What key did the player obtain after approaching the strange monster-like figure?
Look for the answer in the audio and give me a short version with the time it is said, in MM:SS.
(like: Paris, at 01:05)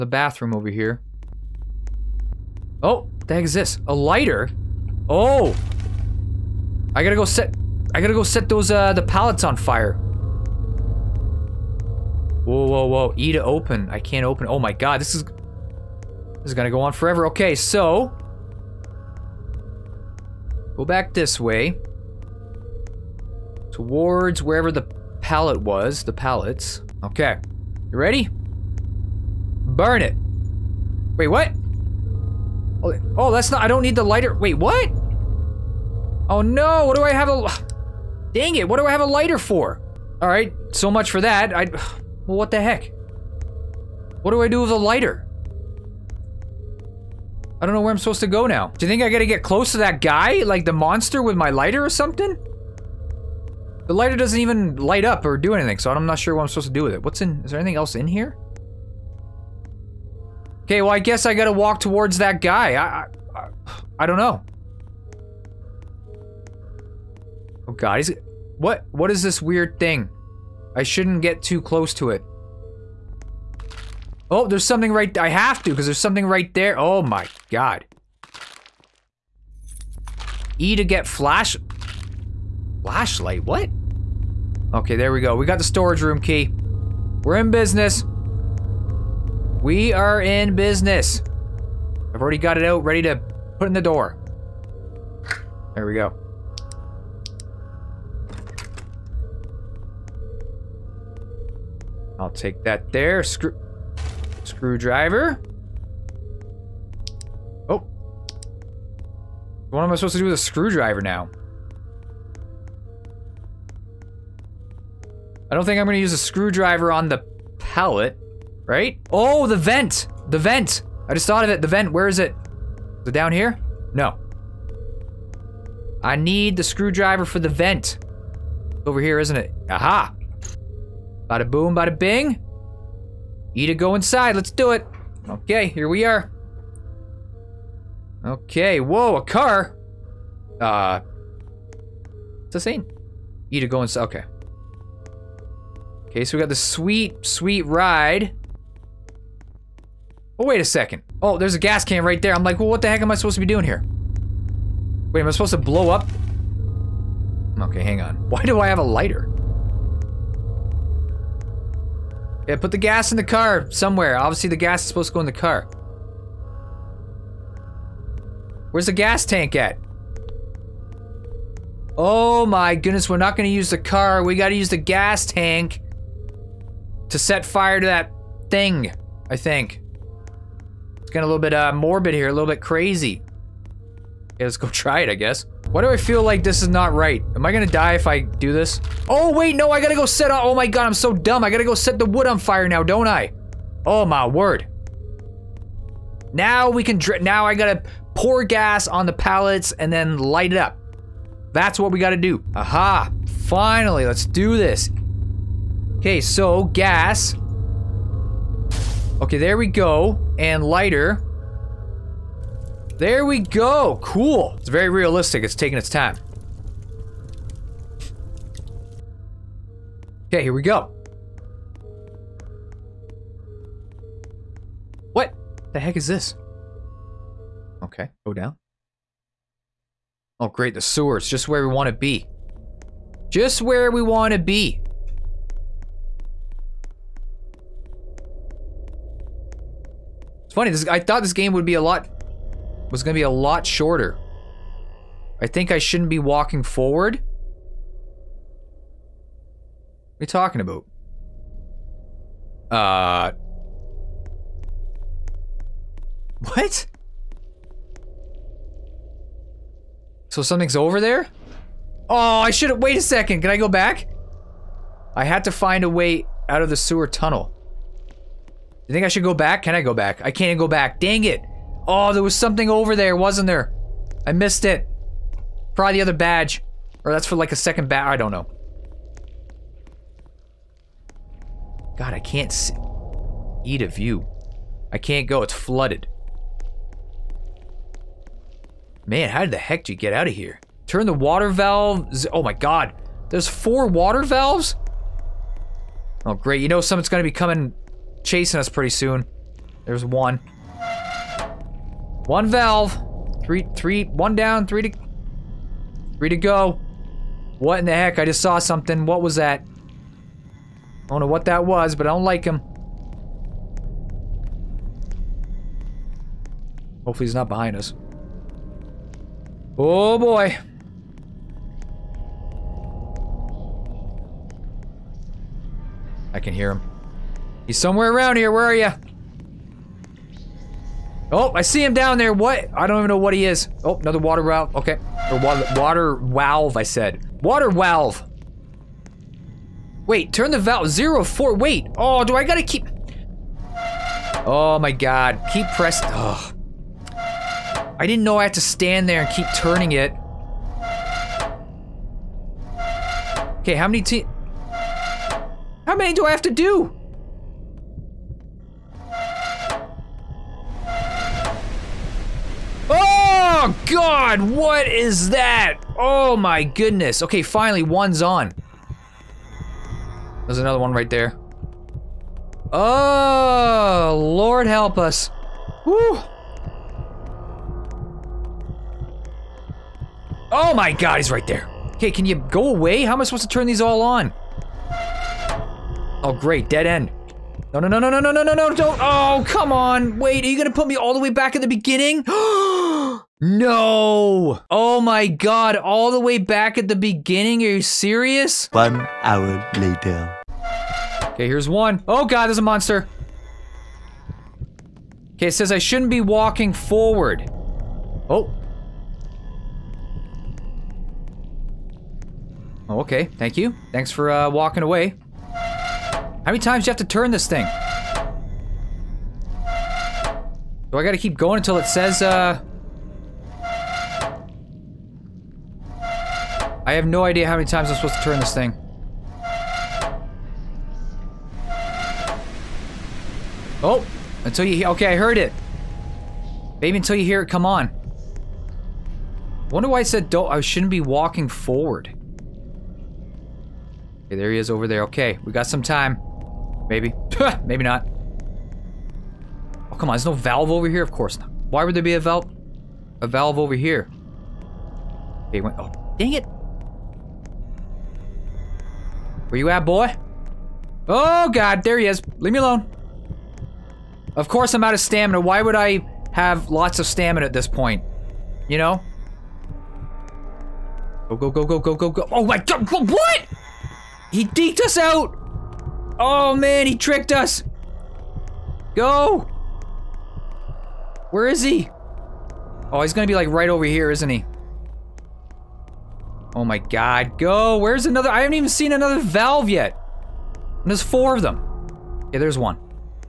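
Storage room key, at 01:25.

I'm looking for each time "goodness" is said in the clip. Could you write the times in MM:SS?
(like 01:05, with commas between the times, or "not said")
02:52, 06:06.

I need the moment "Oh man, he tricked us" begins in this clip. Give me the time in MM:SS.
07:56.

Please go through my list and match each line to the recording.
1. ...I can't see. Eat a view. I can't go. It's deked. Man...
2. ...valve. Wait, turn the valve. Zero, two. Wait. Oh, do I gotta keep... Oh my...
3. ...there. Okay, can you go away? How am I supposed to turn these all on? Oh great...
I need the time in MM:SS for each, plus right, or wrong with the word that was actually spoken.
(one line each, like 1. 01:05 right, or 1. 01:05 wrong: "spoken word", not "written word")
1. 04:42 wrong: "flooded", not "deked"
2. 05:37 wrong: "four", not "two"
3. 06:21 right.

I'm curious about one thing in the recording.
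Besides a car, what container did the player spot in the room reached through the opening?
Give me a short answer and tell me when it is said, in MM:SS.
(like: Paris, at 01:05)
Gas can, at 02:31.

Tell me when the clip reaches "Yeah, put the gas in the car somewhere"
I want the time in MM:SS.
02:42.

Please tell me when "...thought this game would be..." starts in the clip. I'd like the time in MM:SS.
04:01.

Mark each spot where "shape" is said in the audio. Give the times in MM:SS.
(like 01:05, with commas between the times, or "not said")
not said.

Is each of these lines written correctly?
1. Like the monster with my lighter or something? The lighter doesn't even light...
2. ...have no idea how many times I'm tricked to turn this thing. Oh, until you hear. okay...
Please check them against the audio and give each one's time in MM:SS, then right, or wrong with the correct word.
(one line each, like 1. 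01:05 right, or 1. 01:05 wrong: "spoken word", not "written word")
1. 00:50 right
2. 07:06 wrong: "supposed", not "tricked".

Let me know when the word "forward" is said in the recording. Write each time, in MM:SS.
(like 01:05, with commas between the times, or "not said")
04:06, 06:46, 07:21.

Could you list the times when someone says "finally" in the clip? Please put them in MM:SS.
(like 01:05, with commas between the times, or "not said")
03:23, 06:07.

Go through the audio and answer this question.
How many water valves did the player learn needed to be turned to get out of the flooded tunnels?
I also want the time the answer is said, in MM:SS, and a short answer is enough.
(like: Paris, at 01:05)
4, at 04:53.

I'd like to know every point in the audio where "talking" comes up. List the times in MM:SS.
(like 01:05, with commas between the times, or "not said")
04:10.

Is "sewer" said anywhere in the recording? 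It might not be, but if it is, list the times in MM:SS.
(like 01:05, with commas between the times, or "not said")
03:50, 04:26.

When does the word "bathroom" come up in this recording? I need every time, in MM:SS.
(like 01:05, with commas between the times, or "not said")
00:00.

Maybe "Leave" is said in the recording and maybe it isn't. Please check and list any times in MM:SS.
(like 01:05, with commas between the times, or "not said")
07:42.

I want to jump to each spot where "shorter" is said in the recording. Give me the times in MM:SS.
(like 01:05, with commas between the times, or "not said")
04:03.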